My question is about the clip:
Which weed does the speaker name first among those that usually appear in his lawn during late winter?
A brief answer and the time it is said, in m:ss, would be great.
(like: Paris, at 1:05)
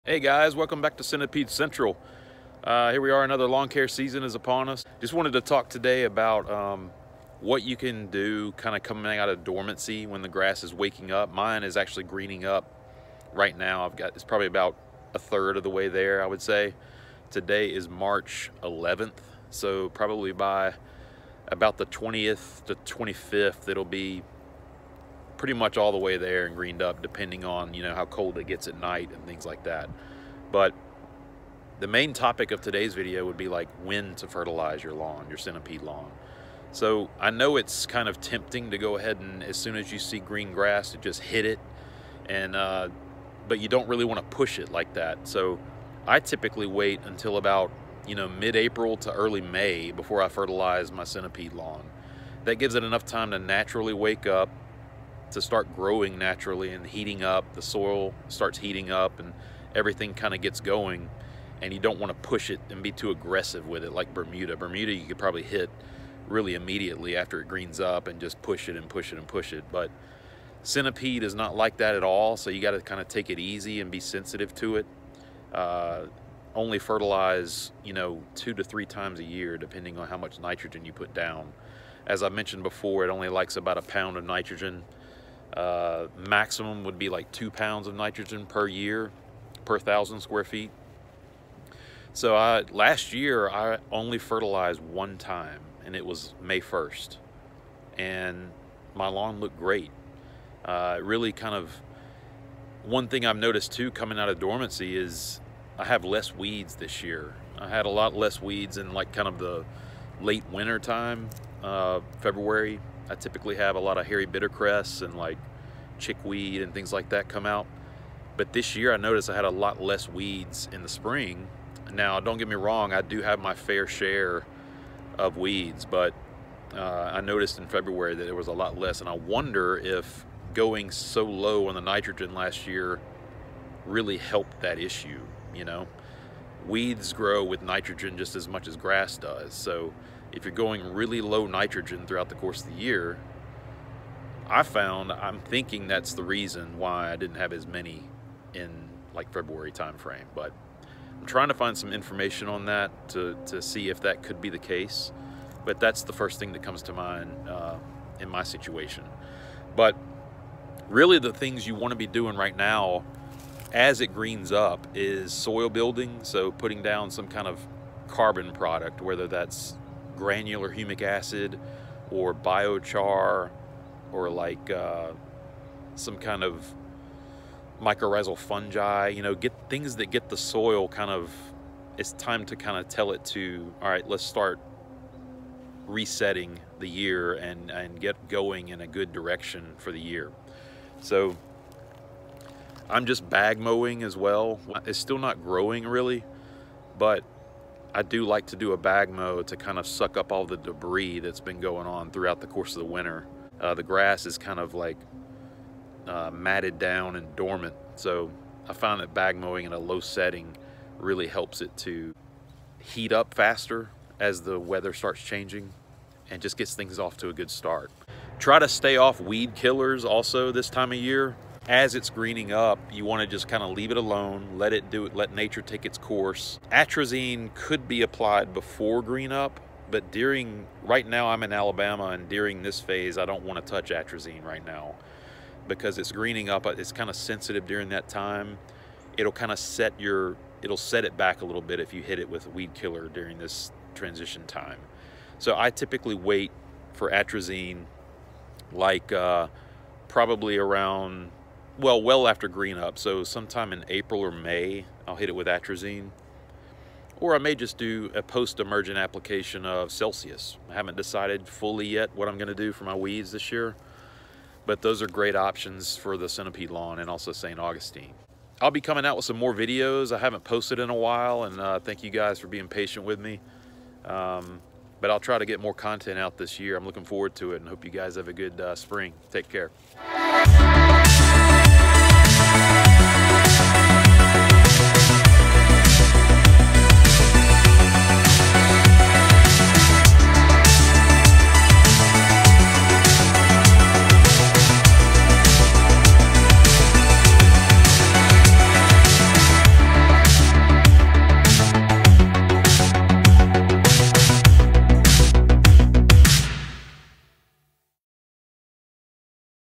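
hairy bittercress, at 1:54.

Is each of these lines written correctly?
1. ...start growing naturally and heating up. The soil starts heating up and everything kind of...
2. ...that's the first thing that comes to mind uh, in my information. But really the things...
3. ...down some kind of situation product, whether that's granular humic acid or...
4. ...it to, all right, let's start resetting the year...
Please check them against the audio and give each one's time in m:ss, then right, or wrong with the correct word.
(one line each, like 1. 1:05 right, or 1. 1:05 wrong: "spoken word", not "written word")
1. 0:55 right
2. 2:35 wrong: "situation", not "information"
3. 2:46 wrong: "carbon", not "situation"
4. 3:03 right.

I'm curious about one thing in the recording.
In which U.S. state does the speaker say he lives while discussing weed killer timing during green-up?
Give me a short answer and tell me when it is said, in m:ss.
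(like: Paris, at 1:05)
Alabama, at 3:51.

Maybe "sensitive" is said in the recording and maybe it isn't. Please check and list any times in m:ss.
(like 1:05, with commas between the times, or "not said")
1:13, 3:57.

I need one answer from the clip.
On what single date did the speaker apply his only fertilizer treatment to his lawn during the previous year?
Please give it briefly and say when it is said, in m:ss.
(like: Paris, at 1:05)
May 1st, at 1:36.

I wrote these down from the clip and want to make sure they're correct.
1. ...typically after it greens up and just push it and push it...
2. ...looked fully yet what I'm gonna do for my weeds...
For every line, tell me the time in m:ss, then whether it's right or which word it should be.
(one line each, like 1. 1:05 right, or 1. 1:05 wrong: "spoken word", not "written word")
1. 1:06 wrong: "immediately", not "typically"
2. 4:20 wrong: "decided", not "looked".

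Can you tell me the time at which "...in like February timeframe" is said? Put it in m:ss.
2:28.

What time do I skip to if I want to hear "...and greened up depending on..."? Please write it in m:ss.
0:26.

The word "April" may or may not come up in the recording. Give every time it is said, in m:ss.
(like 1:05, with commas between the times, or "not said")
0:48, 4:13.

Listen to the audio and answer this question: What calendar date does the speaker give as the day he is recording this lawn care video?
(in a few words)
March 11th.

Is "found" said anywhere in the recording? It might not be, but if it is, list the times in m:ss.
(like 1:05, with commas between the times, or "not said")
2:24.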